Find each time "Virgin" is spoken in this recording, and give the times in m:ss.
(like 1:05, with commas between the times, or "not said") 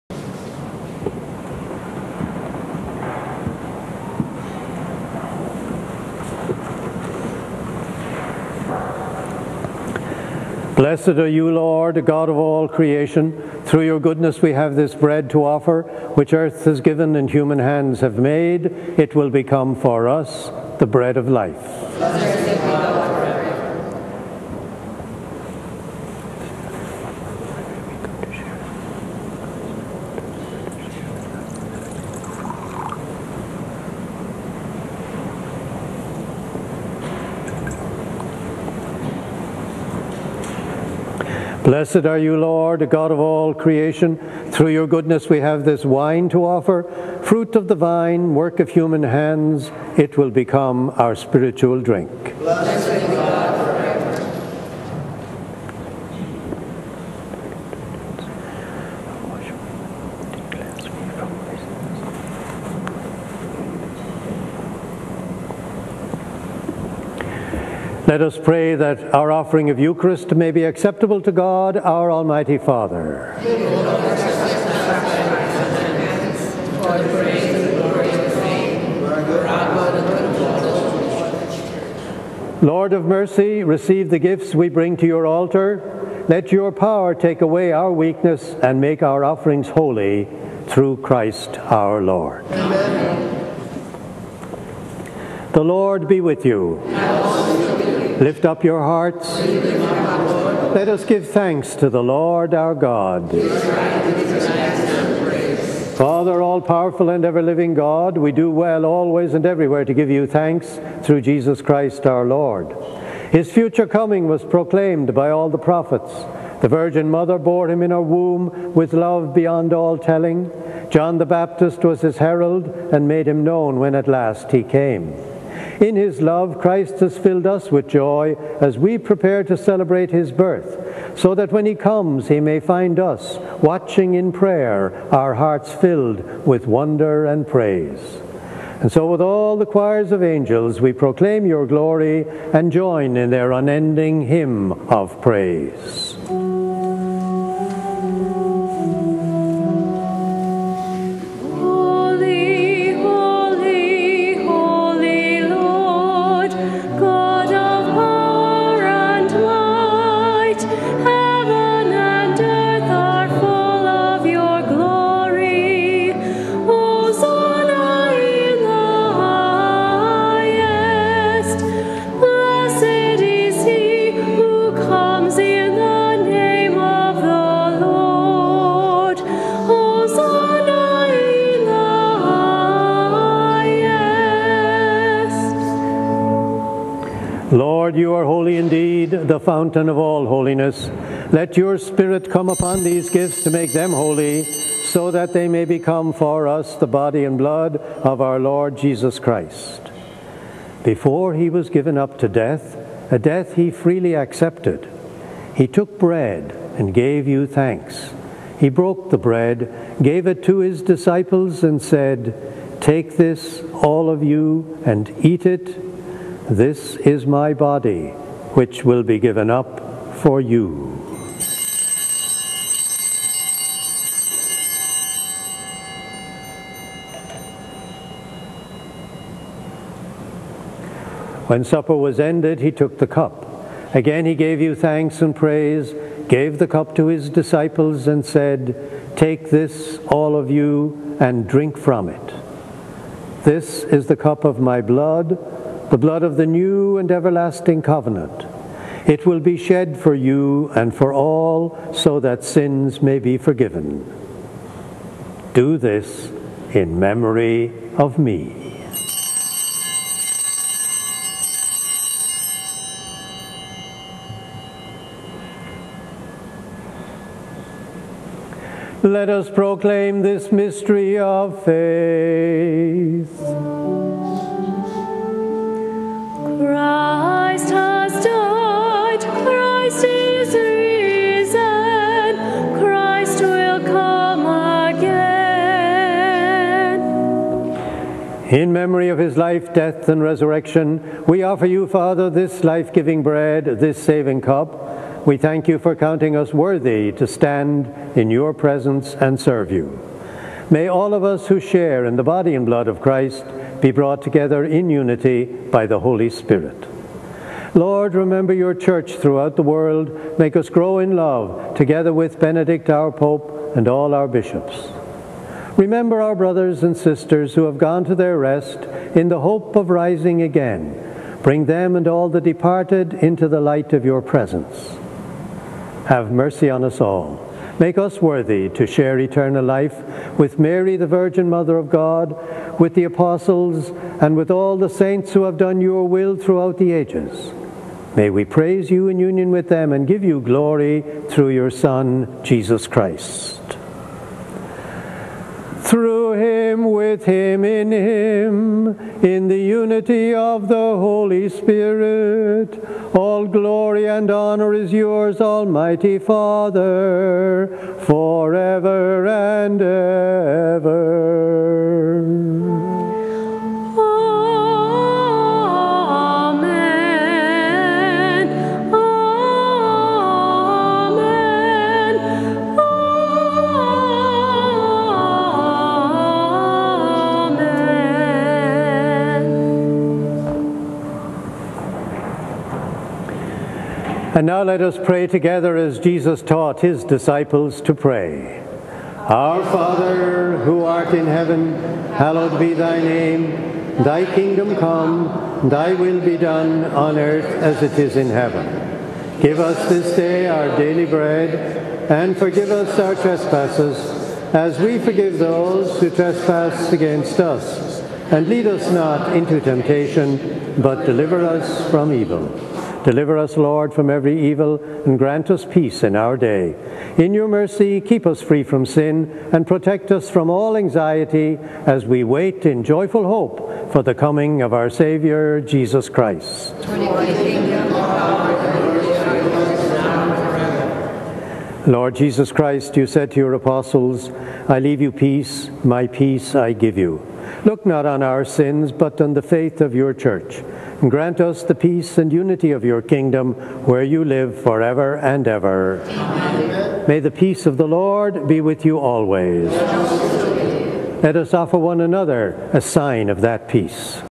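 1:56, 5:31.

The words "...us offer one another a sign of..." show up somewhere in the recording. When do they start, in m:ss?
7:31.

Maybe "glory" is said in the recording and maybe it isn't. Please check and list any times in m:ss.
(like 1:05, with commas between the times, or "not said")
2:21, 5:40, 5:53.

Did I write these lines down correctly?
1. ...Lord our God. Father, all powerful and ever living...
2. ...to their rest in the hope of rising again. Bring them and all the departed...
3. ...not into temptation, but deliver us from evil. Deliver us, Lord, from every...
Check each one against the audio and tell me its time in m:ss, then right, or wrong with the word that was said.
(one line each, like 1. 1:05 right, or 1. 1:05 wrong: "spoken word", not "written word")
1. 1:42 right
2. 5:18 right
3. 6:48 right.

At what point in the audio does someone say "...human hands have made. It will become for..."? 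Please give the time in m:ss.
0:17.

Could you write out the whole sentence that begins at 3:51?
When supper was ended, he took the cup.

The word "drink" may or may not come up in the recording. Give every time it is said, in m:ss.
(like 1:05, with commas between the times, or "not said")
0:51, 4:01.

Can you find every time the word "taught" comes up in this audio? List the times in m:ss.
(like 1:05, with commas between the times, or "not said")
6:26.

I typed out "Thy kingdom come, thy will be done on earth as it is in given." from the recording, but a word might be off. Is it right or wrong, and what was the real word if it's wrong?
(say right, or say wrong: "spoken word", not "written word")
wrong: "heaven", not "given".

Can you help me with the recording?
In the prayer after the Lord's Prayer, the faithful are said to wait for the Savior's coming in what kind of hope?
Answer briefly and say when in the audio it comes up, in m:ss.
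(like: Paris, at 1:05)
joyful hope, at 7:02.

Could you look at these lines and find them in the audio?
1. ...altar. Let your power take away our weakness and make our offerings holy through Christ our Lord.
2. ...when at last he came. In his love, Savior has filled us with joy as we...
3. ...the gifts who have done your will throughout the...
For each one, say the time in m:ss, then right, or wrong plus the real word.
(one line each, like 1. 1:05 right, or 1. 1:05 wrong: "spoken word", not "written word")
1. 1:25 right
2. 2:03 wrong: "Christ", not "Savior"
3. 5:34 wrong: "saints", not "gifts".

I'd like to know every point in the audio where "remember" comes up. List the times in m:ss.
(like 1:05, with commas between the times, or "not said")
5:08, 5:15.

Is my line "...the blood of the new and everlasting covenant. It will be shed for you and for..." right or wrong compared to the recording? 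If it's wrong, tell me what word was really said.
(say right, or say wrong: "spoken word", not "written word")
right.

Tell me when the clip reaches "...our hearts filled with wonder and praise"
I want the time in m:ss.
2:15.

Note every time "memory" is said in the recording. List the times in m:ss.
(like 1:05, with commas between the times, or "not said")
4:16, 4:48.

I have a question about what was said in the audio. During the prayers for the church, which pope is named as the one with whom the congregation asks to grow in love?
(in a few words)
Benedict.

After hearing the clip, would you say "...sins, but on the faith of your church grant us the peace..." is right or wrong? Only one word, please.
right.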